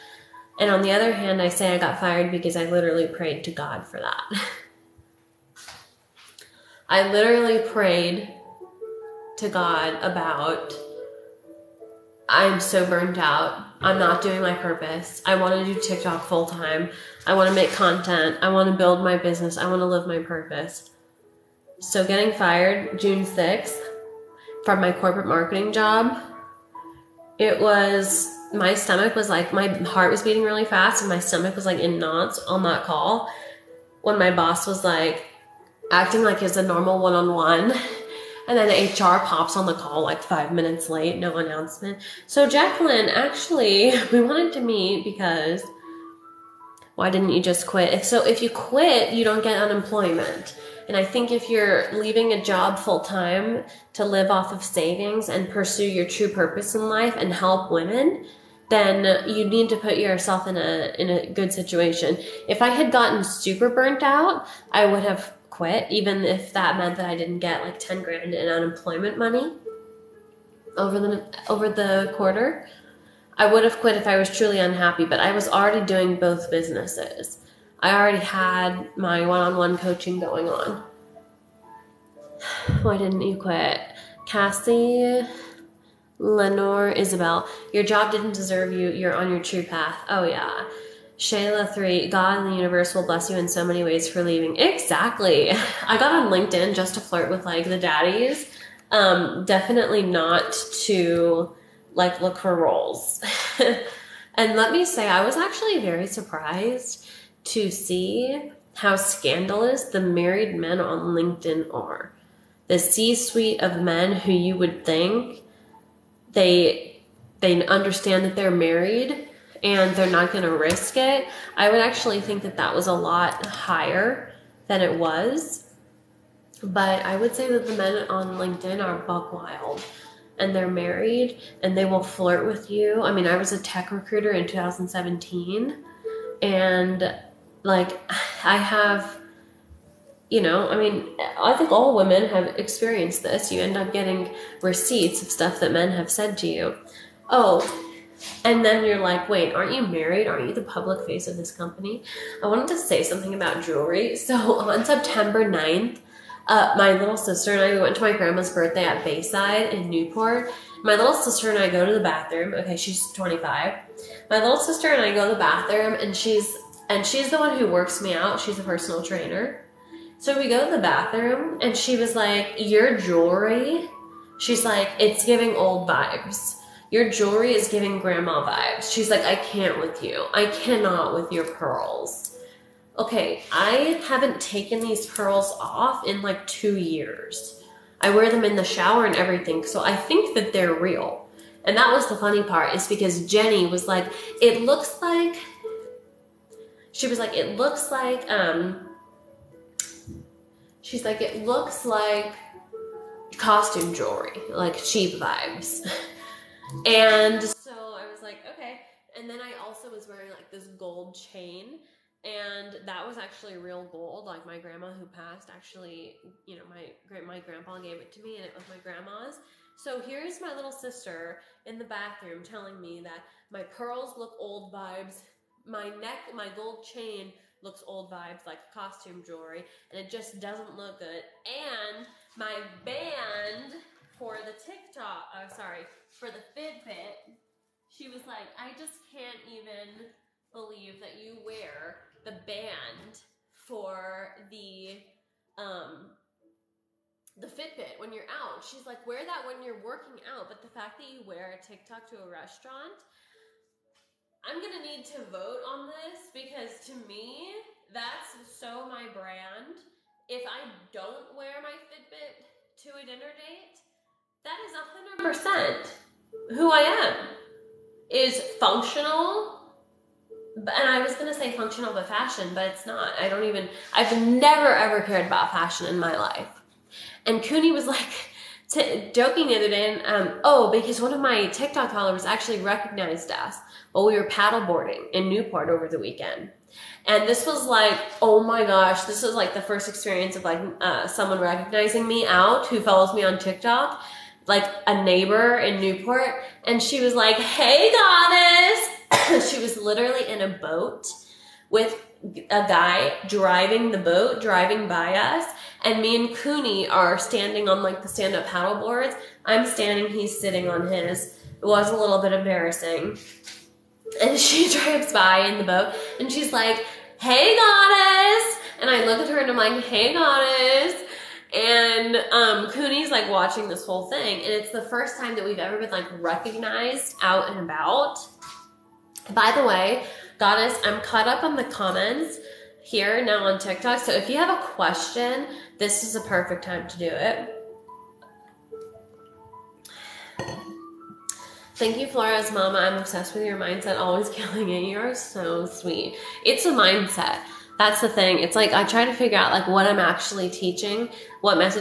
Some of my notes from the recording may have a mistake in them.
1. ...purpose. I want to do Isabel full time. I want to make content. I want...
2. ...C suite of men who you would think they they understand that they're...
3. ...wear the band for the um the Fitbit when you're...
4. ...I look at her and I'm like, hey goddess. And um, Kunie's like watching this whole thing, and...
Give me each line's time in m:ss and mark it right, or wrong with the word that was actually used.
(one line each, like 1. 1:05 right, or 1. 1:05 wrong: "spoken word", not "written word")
1. 0:14 wrong: "TikTok", not "Isabel"
2. 1:52 right
3. 4:01 right
4. 5:18 right.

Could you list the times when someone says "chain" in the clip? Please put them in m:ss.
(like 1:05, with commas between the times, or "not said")
3:31, 3:46.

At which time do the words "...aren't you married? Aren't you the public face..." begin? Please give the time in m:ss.
2:29.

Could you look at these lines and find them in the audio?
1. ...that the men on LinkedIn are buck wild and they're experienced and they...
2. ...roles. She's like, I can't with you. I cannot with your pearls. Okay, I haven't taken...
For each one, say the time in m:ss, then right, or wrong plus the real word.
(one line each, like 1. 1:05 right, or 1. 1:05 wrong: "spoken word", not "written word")
1. 2:07 wrong: "married", not "experienced"
2. 2:58 wrong: "vibes", not "roles".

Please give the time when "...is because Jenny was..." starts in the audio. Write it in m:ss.
3:12.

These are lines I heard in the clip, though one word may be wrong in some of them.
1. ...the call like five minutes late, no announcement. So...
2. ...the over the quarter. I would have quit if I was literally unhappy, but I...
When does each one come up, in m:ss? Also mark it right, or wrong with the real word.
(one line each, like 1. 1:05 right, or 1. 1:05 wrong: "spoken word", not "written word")
1. 0:39 right
2. 1:10 wrong: "truly", not "literally".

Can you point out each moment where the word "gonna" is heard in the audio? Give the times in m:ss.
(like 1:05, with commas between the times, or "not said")
4:14, 4:31.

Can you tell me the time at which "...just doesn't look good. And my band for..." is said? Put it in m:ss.
3:50.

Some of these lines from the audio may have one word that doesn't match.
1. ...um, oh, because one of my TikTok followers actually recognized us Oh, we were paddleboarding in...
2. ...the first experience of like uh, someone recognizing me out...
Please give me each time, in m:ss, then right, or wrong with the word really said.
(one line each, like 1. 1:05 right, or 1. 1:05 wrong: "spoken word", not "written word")
1. 4:40 right
2. 4:49 right.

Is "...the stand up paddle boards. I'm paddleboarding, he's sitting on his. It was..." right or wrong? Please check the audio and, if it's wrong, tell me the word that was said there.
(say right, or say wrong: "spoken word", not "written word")
wrong: "standing", not "paddleboarding".